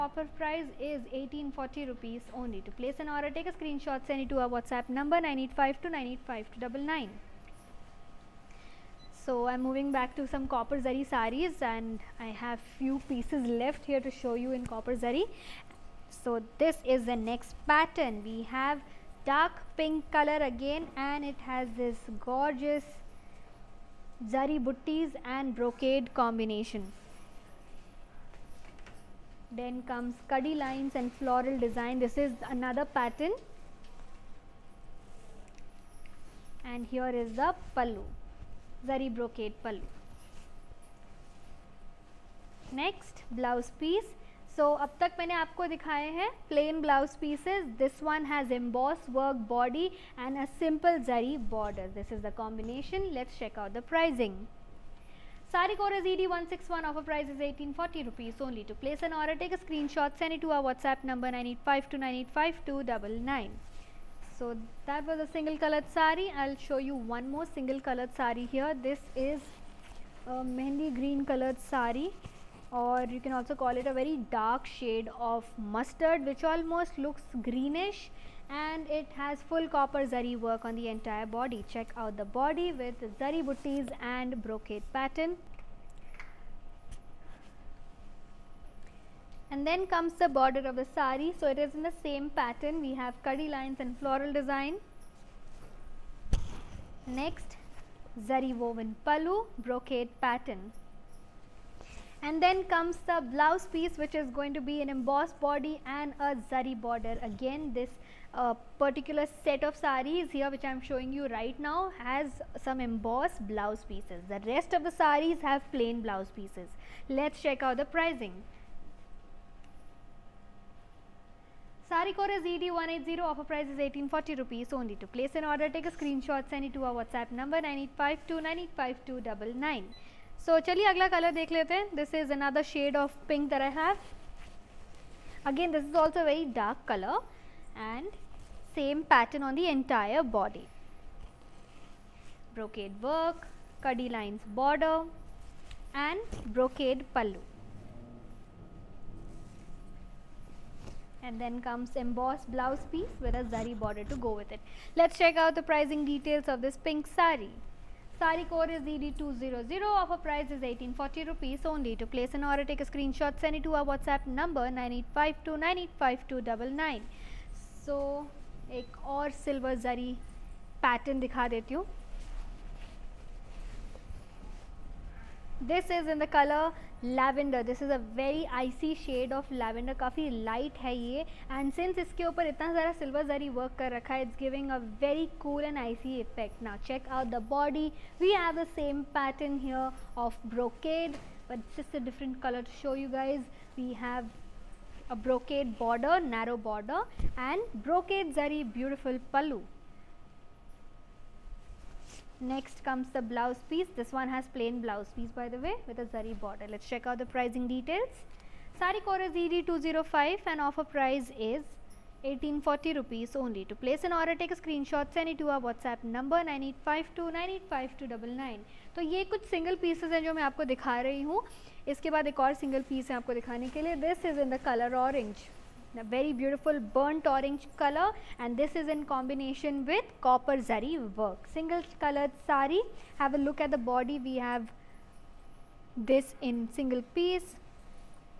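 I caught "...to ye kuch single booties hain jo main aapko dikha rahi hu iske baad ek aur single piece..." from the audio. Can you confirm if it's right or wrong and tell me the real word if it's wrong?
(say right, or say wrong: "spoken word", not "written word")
wrong: "pieces", not "booties".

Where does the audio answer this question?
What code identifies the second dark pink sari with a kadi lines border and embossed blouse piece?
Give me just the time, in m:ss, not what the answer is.
2:38.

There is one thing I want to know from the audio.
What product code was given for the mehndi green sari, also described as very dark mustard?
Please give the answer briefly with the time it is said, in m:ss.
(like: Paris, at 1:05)
ED180, at 2:01.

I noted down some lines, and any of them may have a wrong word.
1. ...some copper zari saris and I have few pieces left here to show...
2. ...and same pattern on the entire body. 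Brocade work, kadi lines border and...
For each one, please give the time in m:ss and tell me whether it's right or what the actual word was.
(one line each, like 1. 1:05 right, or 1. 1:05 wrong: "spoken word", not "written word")
1. 0:10 right
2. 2:17 right.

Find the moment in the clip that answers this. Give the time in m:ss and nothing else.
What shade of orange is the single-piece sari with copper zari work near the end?
3:46.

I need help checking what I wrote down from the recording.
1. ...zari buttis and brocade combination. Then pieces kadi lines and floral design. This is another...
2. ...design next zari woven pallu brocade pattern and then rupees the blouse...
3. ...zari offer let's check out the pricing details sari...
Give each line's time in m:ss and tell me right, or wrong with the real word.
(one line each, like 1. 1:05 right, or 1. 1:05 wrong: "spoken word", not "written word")
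1. 0:24 wrong: "comes", not "pieces"
2. 1:34 wrong: "comes", not "rupees"
3. 3:26 wrong: "border", not "offer".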